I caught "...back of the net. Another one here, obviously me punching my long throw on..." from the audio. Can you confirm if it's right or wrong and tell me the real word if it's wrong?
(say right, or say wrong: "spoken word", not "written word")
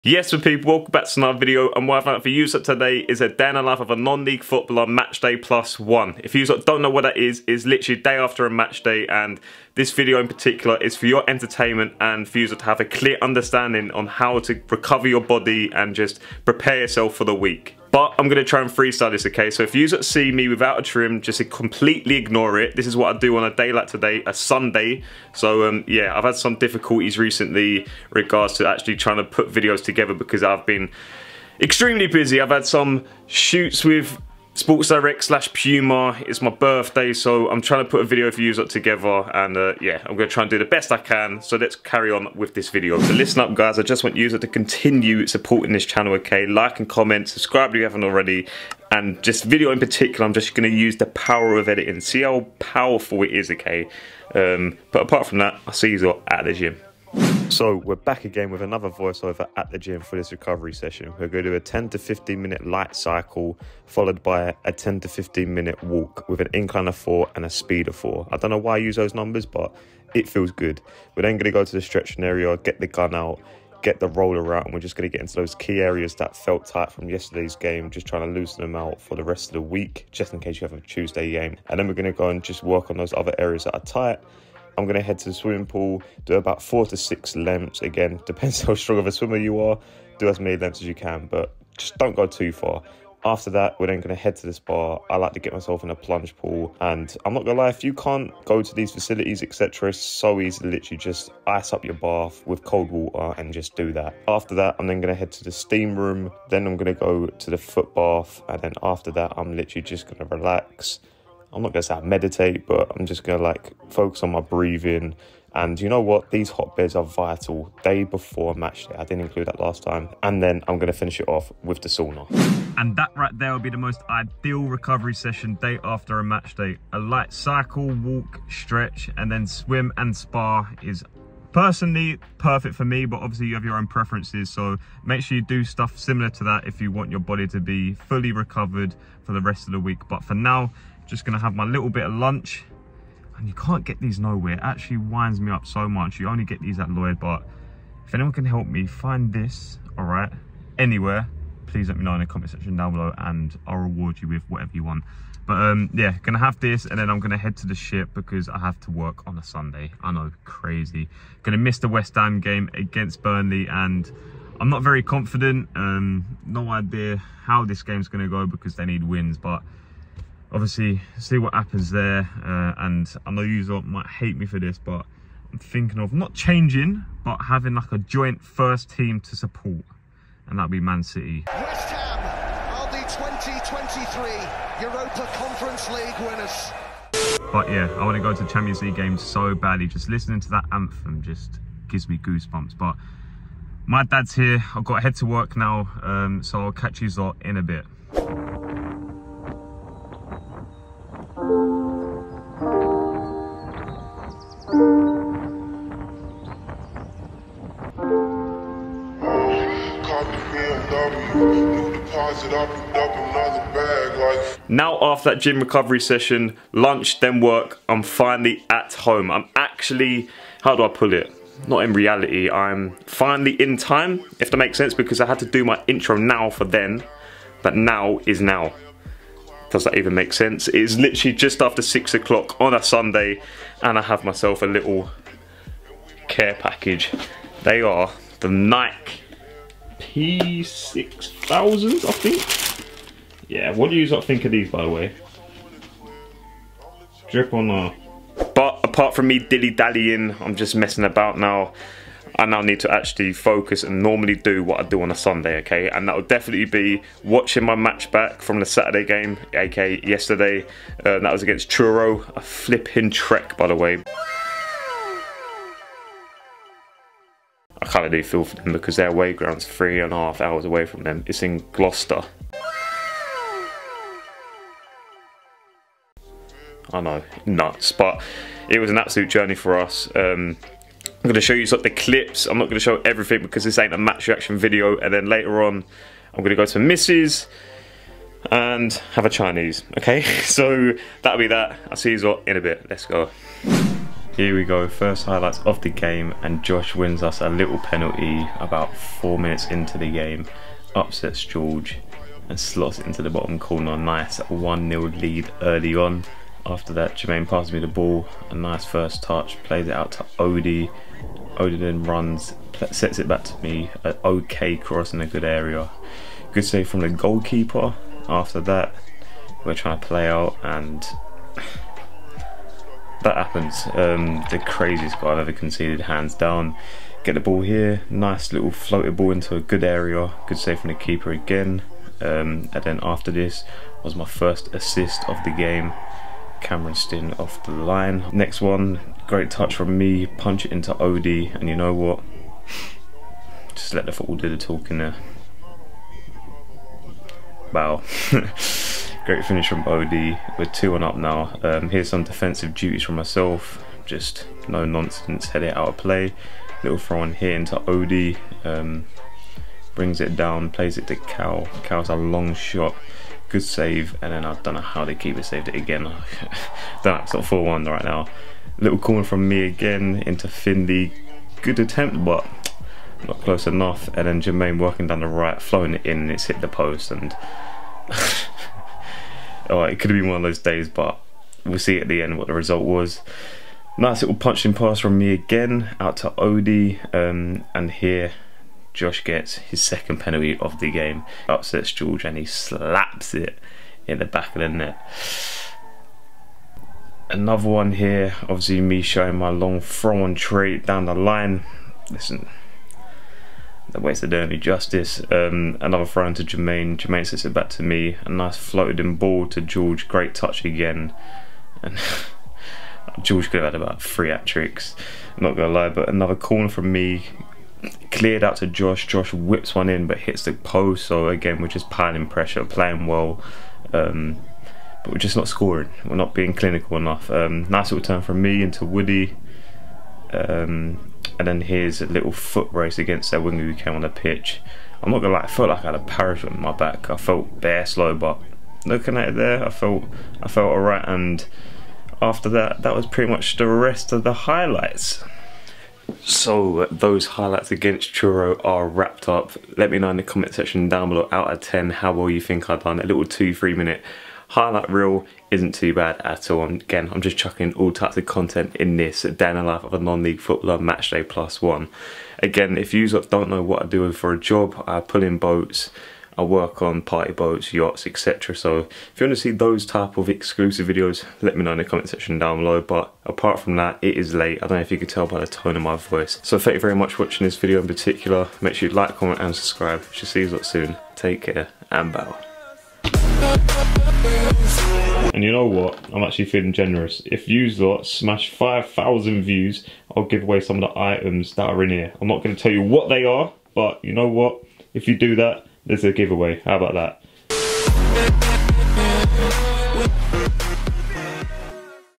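wrong: "showing", not "punching".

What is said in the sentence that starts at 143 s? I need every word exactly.
And you can't get these nowhere.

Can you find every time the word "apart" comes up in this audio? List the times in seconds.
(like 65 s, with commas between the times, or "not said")
55 s, 248 s, 473 s.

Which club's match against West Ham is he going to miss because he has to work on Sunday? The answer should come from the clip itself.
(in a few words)
Burnley.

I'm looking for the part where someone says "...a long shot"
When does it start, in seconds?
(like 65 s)
362 s.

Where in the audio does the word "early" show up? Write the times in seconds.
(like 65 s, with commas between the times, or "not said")
305 s, 404 s.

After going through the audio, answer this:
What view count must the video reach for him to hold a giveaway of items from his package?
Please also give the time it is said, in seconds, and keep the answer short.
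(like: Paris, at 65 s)
5,000, at 488 s.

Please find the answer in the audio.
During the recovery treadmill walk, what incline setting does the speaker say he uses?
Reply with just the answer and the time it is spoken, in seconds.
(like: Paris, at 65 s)
4, at 66 s.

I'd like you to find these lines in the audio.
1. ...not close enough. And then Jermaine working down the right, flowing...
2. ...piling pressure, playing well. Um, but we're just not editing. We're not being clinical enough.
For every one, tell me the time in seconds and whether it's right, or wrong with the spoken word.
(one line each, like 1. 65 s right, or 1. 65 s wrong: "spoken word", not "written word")
1. 373 s right
2. 421 s wrong: "scoring", not "editing".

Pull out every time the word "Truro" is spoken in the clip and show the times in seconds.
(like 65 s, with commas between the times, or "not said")
261 s, 448 s.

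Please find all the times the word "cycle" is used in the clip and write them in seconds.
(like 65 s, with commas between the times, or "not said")
62 s, 127 s.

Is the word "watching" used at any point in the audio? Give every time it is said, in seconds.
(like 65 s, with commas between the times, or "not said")
257 s, 477 s.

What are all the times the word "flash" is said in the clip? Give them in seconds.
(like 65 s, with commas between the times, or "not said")
not said.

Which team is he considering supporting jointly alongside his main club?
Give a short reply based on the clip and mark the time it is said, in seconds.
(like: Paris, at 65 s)
Man City, at 180 s.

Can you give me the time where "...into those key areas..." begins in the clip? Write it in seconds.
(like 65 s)
75 s.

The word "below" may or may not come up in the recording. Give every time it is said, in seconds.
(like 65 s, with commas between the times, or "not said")
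152 s, 451 s, 472 s.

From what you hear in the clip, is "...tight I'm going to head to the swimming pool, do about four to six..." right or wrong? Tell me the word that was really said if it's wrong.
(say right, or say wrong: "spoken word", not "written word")
right.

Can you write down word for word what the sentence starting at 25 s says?
So um, yeah, I've had some difficulties recently regards to actually trying to put videos together because I've been extremely busy.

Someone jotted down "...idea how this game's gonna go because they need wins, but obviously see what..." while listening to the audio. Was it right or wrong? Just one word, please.
right.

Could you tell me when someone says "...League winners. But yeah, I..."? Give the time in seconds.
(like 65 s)
185 s.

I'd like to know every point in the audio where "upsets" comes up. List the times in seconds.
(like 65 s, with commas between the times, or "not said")
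300 s, 391 s.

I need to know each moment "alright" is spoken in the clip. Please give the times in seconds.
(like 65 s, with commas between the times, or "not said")
440 s.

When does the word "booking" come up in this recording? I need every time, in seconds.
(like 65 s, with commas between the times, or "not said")
not said.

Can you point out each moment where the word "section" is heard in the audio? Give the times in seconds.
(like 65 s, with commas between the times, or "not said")
152 s, 450 s, 472 s.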